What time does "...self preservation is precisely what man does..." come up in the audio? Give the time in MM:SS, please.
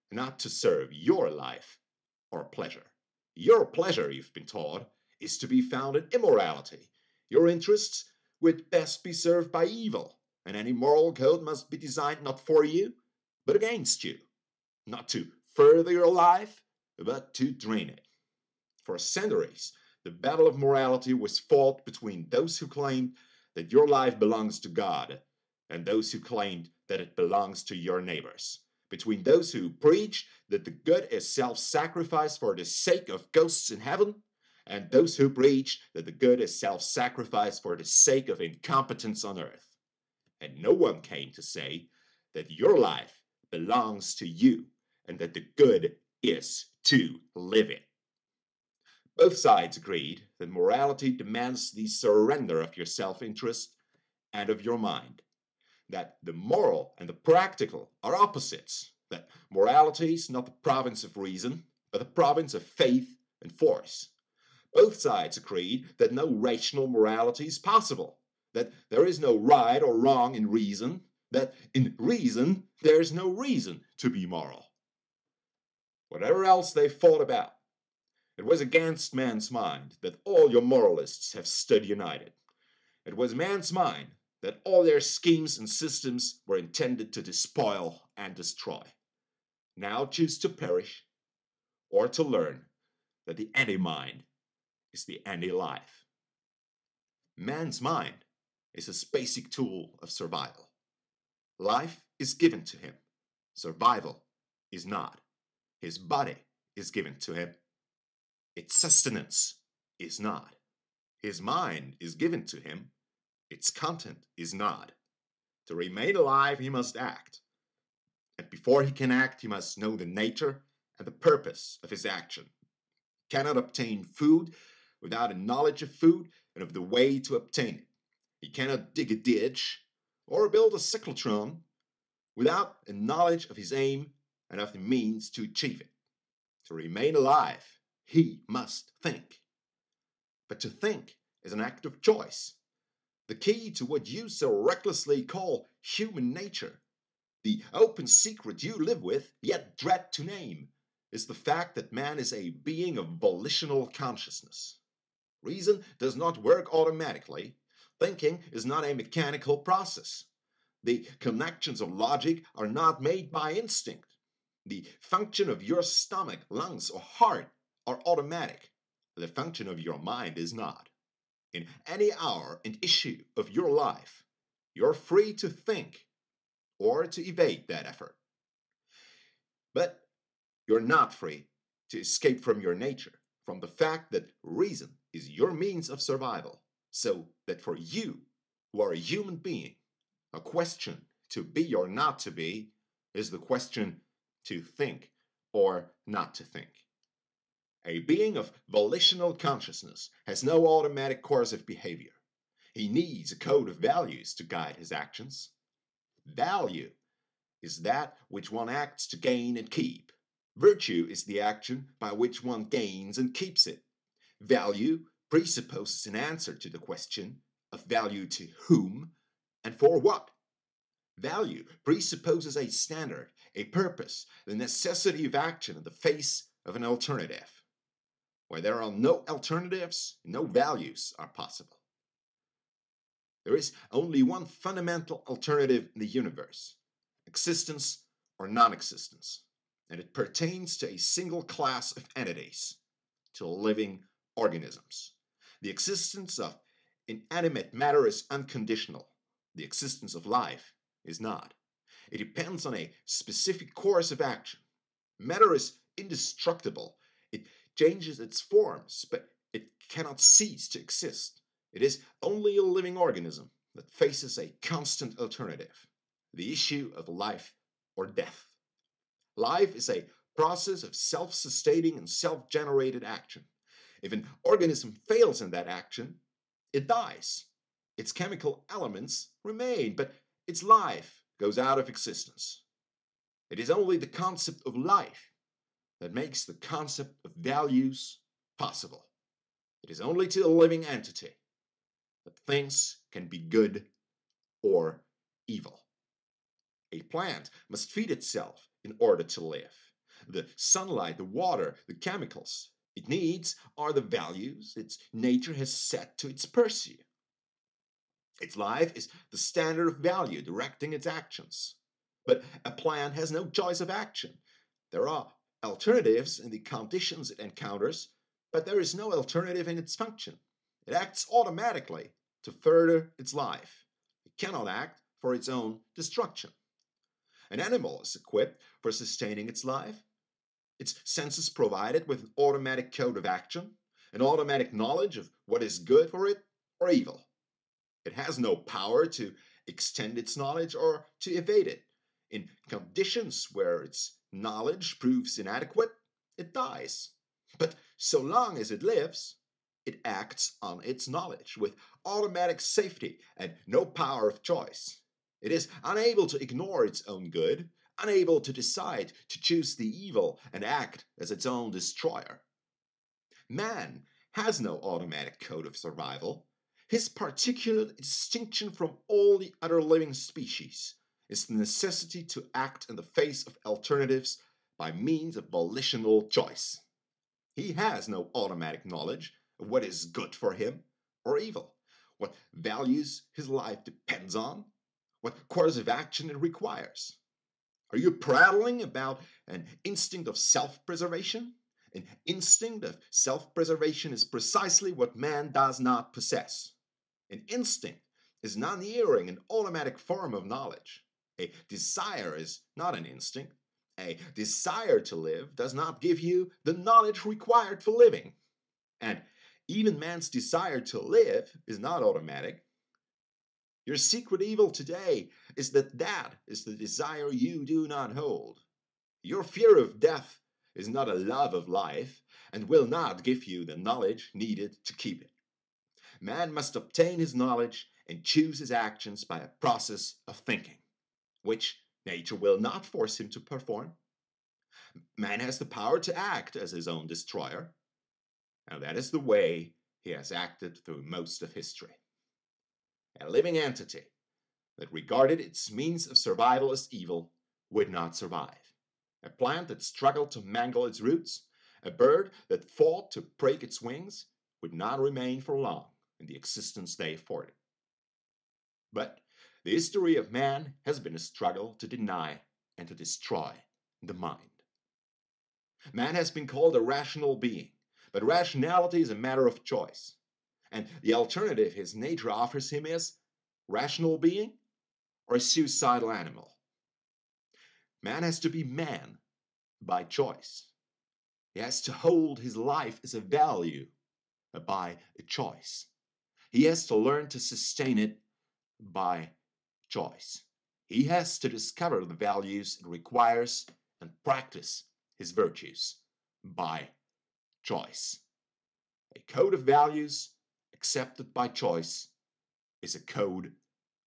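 06:33.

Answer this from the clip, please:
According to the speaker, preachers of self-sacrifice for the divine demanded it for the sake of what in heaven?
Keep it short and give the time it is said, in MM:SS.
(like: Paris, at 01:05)
ghosts, at 00:33.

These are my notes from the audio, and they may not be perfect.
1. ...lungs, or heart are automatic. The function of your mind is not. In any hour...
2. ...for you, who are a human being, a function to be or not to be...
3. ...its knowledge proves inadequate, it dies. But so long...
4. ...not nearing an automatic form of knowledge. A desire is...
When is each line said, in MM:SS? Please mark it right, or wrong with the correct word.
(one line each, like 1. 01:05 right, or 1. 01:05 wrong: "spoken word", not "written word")
1. 02:46 right
2. 03:07 wrong: "question", not "function"
3. 05:43 right
4. 06:38 right.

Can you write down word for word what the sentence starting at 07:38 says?
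But the history of man has been a struggle to deny and to destroy the mind.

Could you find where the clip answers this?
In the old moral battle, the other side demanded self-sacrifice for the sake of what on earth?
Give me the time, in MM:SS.
00:38.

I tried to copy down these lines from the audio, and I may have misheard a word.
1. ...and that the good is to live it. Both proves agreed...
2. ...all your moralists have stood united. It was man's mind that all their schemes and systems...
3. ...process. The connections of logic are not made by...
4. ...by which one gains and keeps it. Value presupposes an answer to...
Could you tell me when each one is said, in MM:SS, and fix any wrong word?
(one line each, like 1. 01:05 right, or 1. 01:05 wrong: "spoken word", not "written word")
1. 00:45 wrong: "sides", not "proves"
2. 01:20 right
3. 02:39 right
4. 03:31 right.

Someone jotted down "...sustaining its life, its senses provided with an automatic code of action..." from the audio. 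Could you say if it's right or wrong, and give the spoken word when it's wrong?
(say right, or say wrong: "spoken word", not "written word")
right.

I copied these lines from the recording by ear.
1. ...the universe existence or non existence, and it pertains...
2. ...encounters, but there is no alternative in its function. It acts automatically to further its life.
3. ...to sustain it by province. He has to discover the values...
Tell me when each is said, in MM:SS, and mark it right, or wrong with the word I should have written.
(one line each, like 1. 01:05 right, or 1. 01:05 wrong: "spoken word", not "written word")
1. 03:55 right
2. 05:17 right
3. 08:07 wrong: "choice", not "province".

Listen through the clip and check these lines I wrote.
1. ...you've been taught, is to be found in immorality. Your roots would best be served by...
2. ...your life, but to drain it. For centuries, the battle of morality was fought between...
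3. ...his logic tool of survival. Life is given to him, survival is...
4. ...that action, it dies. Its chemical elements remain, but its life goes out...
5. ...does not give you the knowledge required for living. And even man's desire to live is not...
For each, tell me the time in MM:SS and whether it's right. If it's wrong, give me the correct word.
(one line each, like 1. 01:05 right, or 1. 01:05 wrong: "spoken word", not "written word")
1. 00:04 wrong: "interests", not "roots"
2. 00:15 right
3. 01:38 wrong: "basic", not "logic"
4. 04:35 right
5. 06:45 right.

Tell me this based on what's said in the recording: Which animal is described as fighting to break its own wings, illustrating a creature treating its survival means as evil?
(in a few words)
a bird.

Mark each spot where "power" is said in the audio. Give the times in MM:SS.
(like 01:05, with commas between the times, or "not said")
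05:38, 05:53, 07:15.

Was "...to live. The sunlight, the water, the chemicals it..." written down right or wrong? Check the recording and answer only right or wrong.
right.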